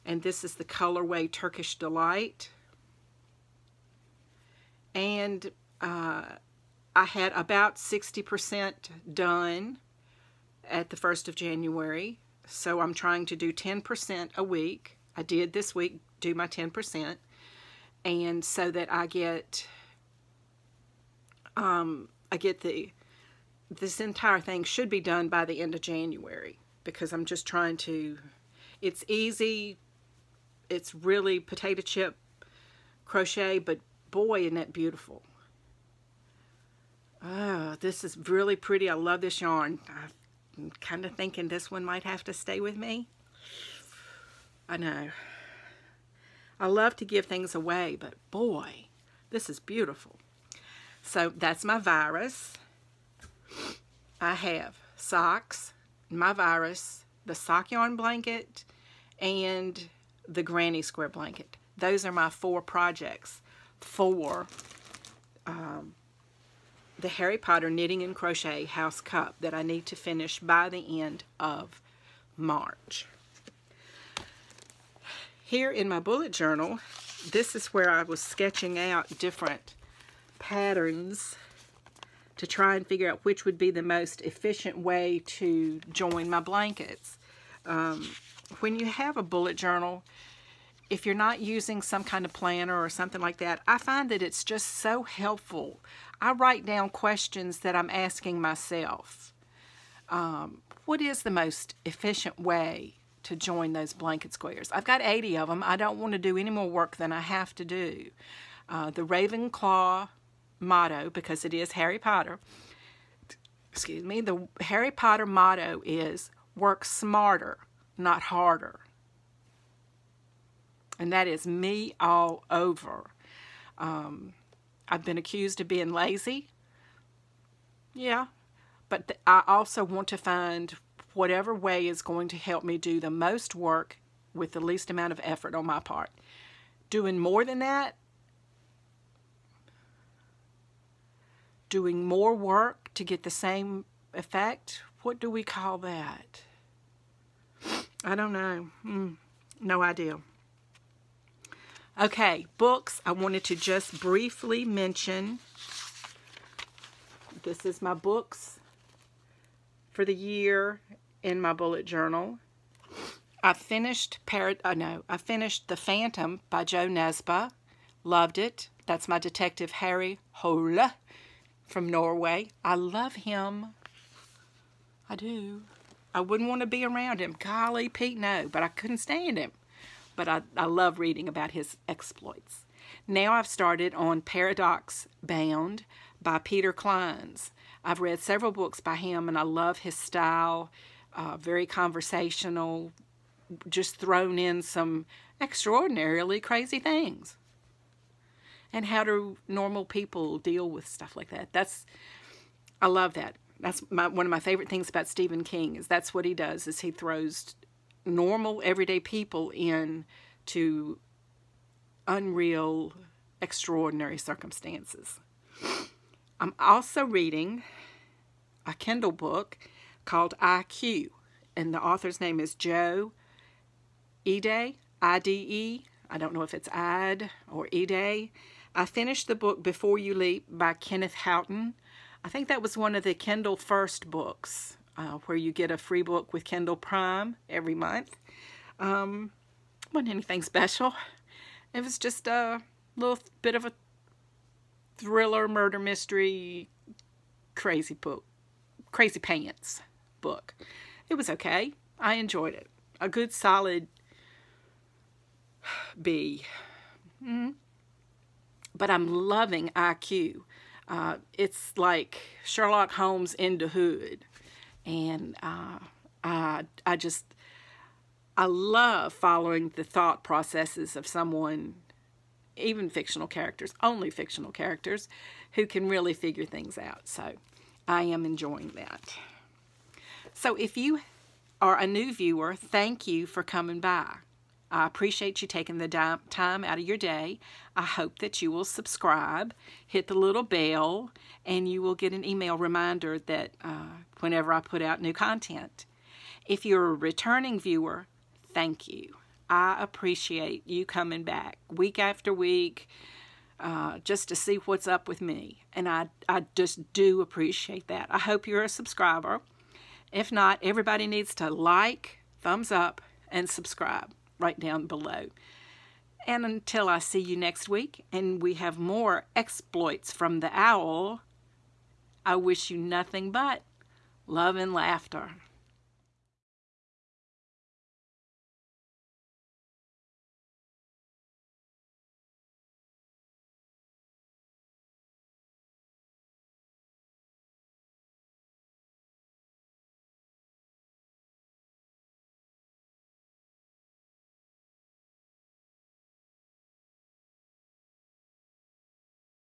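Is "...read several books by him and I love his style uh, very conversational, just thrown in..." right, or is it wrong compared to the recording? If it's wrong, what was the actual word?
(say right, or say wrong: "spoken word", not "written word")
right.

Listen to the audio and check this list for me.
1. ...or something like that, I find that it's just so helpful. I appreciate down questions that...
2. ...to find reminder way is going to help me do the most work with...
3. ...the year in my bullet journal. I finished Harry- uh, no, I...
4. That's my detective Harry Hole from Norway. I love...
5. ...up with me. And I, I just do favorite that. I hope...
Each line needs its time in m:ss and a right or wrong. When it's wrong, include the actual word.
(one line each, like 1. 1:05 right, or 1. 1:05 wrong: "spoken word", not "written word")
1. 1:32 wrong: "write", not "appreciate"
2. 2:10 wrong: "whatever", not "reminder"
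3. 2:40 wrong: "Parad", not "Harry"
4. 2:48 right
5. 5:04 wrong: "appreciate", not "favorite".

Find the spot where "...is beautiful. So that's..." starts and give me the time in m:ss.
0:49.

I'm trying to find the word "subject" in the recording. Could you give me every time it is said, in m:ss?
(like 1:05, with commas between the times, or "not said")
not said.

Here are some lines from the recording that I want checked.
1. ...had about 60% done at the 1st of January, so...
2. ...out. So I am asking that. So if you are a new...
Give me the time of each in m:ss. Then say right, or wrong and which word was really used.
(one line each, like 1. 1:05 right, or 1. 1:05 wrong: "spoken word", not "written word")
1. 0:07 right
2. 4:36 wrong: "enjoying", not "asking".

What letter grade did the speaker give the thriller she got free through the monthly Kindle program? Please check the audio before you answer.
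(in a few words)
B.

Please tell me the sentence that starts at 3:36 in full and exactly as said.
I'm also reading a Kindle book called IQ.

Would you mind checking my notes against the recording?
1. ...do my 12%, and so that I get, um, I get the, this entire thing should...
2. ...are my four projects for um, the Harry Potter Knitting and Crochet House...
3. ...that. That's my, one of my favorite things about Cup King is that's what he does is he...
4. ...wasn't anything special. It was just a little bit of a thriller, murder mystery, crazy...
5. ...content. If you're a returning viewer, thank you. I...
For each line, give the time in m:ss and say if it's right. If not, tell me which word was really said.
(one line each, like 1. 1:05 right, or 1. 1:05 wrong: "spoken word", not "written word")
1. 0:16 wrong: "10", not "12"
2. 1:02 right
3. 3:23 wrong: "Stephen", not "Cup"
4. 3:59 right
5. 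4:55 right.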